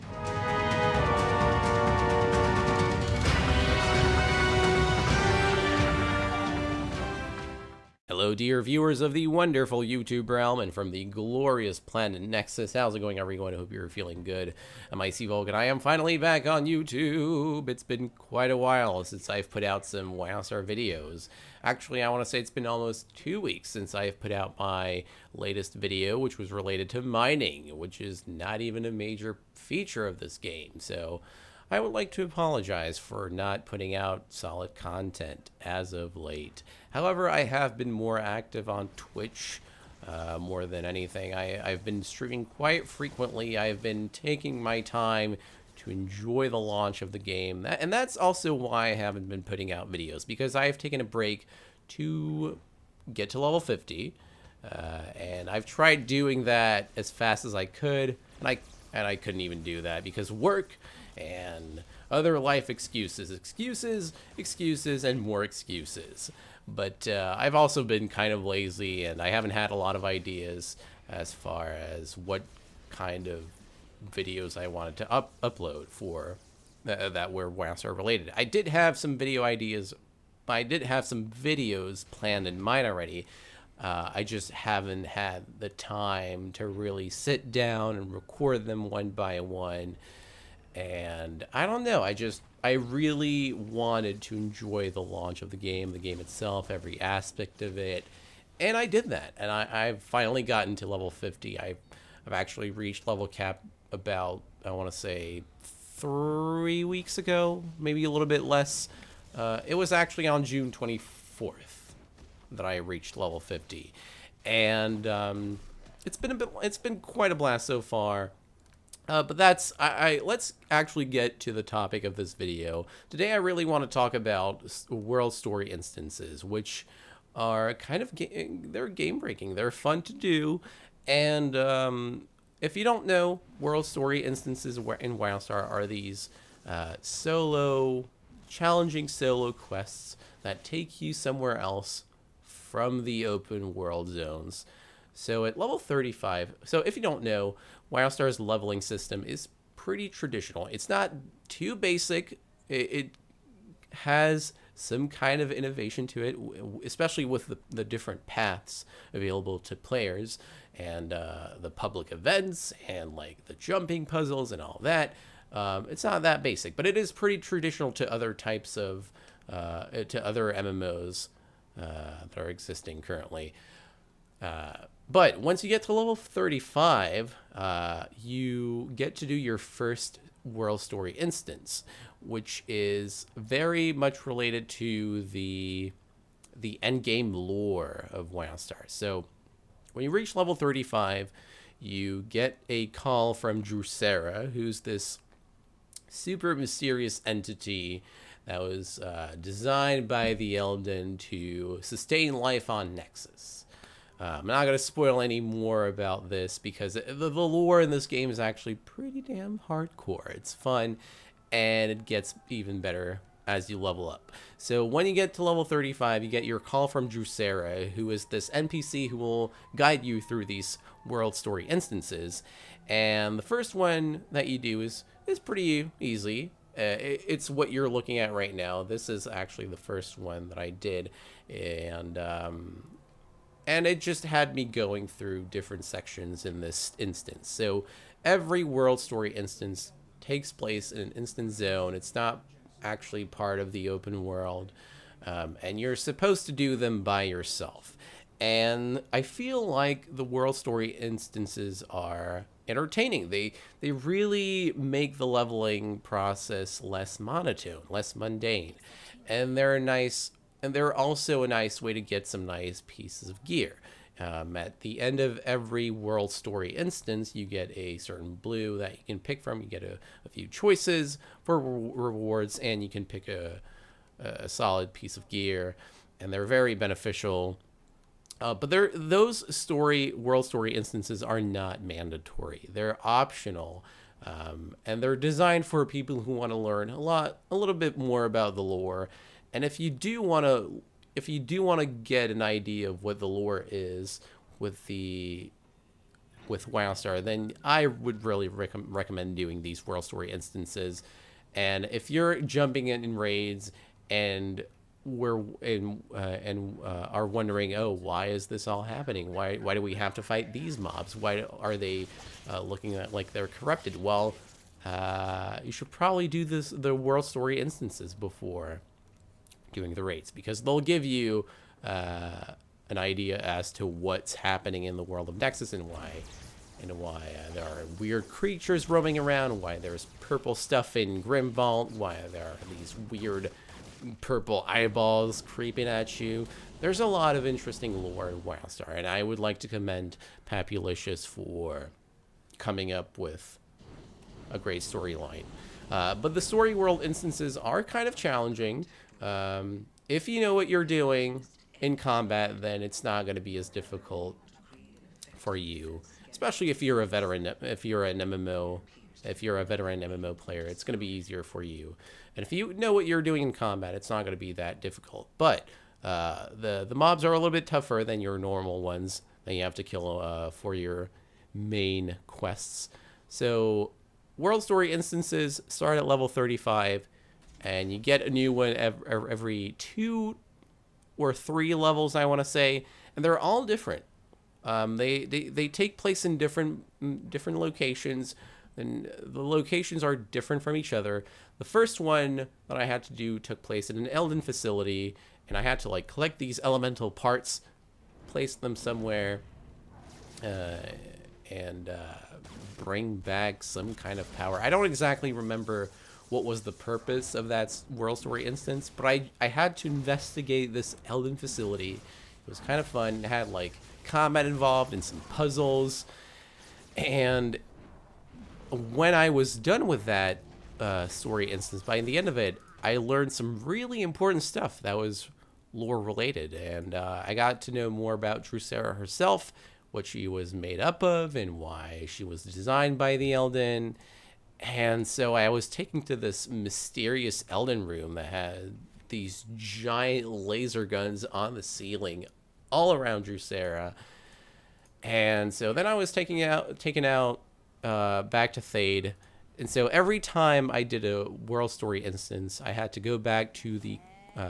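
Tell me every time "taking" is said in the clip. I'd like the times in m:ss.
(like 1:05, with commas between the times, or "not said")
0:44, 7:26.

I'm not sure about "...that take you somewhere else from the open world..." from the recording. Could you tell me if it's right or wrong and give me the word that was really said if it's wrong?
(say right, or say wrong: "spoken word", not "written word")
right.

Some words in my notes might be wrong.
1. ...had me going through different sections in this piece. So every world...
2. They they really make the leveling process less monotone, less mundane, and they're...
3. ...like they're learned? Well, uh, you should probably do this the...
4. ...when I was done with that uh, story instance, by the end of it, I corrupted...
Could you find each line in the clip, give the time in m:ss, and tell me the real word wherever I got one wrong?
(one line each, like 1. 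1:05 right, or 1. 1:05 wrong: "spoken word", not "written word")
1. 3:54 wrong: "instance", not "piece"
2. 4:13 right
3. 5:13 wrong: "corrupted", not "learned"
4. 6:58 wrong: "learned", not "corrupted".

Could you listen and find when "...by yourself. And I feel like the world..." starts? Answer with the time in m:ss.
4:07.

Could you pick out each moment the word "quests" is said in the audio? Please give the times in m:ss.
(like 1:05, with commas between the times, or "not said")
2:19, 6:12.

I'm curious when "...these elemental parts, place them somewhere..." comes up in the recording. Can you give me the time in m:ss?
6:36.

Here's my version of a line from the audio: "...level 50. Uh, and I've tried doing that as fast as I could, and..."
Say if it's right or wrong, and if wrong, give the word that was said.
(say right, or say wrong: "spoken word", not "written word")
right.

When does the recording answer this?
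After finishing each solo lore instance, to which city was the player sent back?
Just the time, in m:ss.
7:28.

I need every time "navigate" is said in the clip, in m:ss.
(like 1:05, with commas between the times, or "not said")
not said.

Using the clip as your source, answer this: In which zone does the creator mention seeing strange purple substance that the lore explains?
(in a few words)
Grimvault.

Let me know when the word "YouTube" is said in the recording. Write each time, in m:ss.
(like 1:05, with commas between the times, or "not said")
0:09, 0:16.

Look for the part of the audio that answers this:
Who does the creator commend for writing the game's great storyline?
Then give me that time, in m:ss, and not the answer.
5:40.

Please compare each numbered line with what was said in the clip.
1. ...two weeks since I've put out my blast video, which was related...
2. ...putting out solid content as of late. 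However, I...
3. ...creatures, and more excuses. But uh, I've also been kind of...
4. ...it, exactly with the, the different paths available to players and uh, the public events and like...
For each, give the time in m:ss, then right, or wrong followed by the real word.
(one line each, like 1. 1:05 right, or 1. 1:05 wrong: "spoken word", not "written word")
1. 0:23 wrong: "latest", not "blast"
2. 0:33 right
3. 1:04 wrong: "excuses", not "creatures"
4. 2:36 wrong: "especially", not "exactly".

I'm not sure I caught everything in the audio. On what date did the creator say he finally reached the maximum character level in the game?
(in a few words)
June 24th.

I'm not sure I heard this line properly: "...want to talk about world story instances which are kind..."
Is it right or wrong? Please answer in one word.
right.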